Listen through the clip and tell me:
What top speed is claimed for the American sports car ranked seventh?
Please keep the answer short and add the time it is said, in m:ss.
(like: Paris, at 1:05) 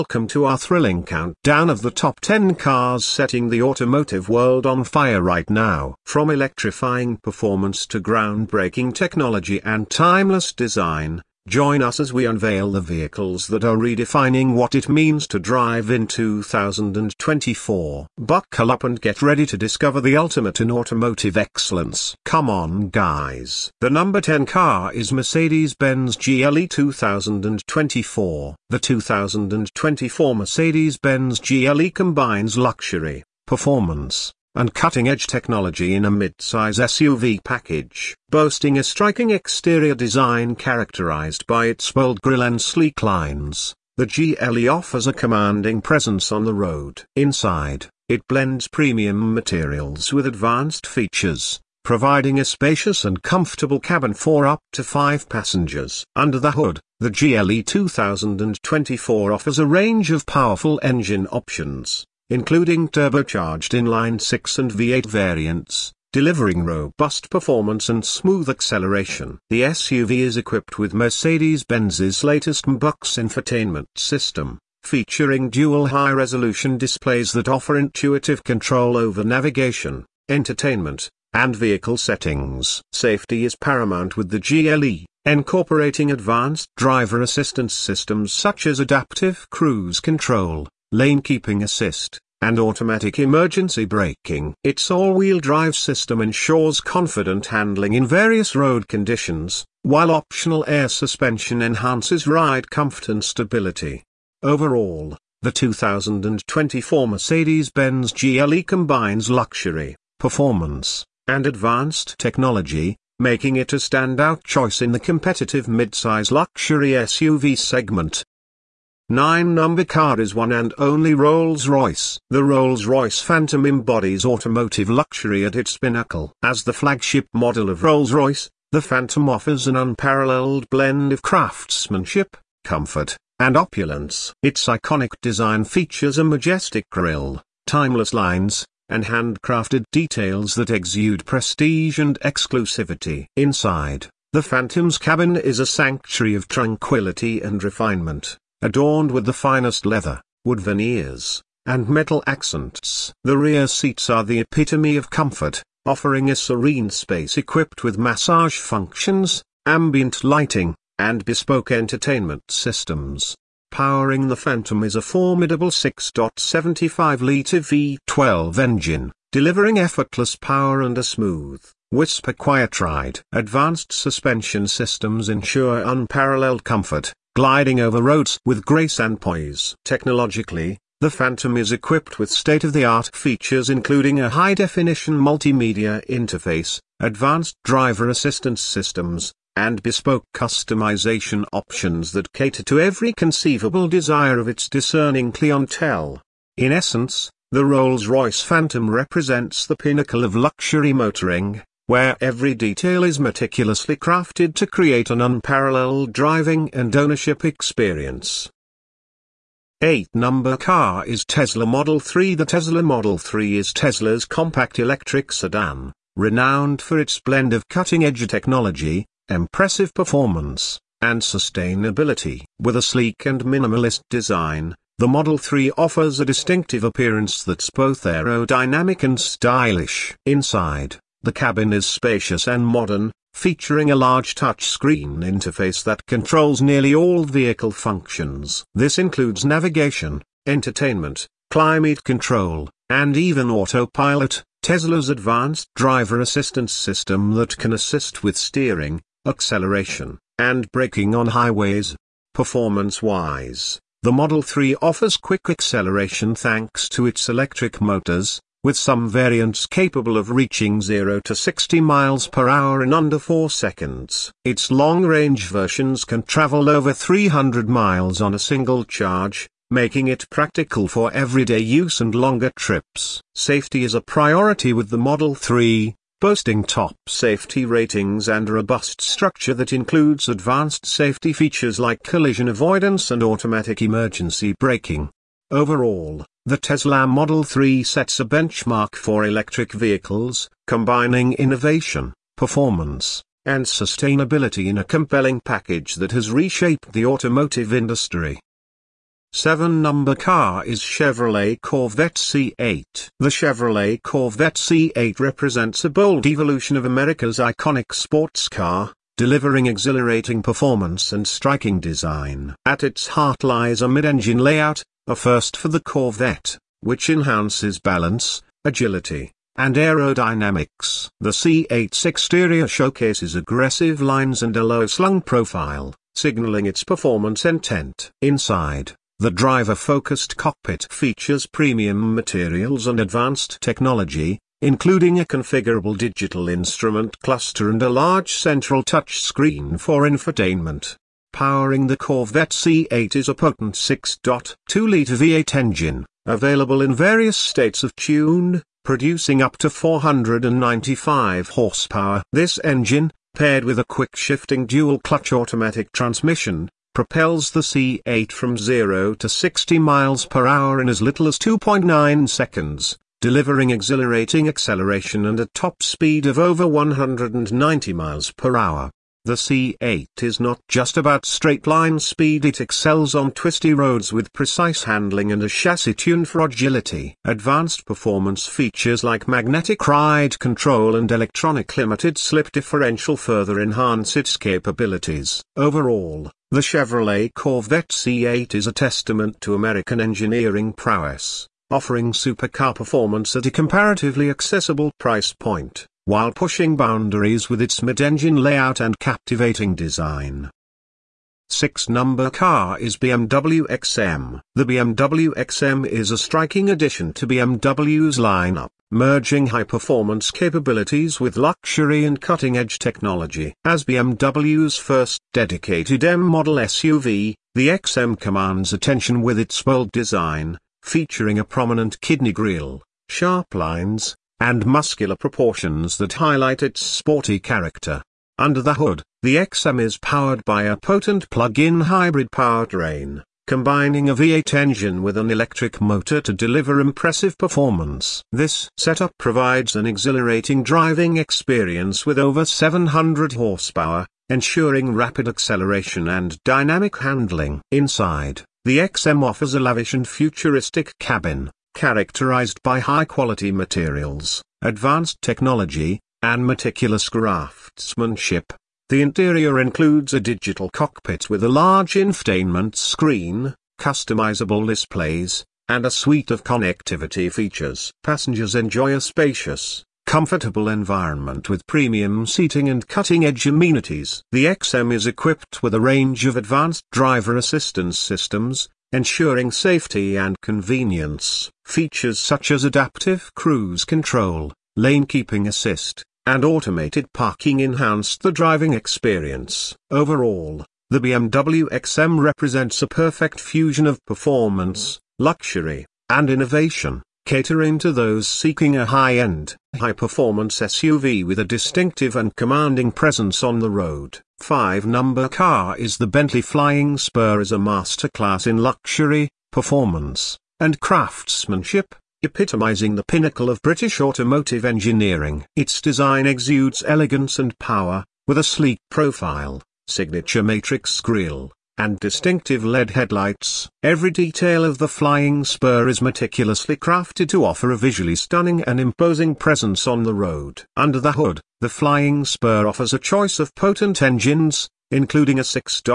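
over 190 miles per hour, at 6:06.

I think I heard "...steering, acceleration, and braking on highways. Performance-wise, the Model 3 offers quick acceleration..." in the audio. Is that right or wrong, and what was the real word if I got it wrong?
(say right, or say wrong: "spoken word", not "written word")
right.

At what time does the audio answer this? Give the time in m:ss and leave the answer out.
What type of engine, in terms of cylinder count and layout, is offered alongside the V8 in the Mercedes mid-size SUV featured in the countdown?
1:02.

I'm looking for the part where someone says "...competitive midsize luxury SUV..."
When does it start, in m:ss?
1:54.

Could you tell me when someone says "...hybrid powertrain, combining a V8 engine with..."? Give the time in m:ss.
7:11.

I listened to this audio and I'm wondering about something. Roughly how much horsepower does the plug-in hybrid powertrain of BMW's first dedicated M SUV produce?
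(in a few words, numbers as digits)
over 700 horsepower.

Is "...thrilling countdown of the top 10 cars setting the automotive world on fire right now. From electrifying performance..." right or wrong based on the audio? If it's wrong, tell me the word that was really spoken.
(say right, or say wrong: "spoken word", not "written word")
right.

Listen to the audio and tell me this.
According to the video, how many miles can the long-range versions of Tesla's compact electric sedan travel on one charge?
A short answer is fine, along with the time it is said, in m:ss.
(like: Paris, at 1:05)
over 300 miles, at 4:26.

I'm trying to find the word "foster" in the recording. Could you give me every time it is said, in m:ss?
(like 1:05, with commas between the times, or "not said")
not said.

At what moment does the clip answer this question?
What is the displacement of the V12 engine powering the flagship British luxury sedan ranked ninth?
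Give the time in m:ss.
2:45.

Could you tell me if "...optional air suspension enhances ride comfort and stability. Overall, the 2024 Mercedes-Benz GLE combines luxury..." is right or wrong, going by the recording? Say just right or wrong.
right.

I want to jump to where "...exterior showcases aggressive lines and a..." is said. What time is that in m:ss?
5:22.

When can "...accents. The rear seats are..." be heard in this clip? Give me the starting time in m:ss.
2:32.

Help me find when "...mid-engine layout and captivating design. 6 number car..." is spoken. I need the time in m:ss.
6:37.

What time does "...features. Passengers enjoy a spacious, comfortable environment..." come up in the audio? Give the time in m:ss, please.
7:47.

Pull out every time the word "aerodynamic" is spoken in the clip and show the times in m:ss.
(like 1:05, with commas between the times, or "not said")
3:48, 5:19.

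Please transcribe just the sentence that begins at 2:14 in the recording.
Its iconic design features a majestic grille, timeless lines, and handcrafted details that exude prestige and exclusivity.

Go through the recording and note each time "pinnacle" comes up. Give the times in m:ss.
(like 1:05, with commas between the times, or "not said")
2:05, 3:19, 8:33.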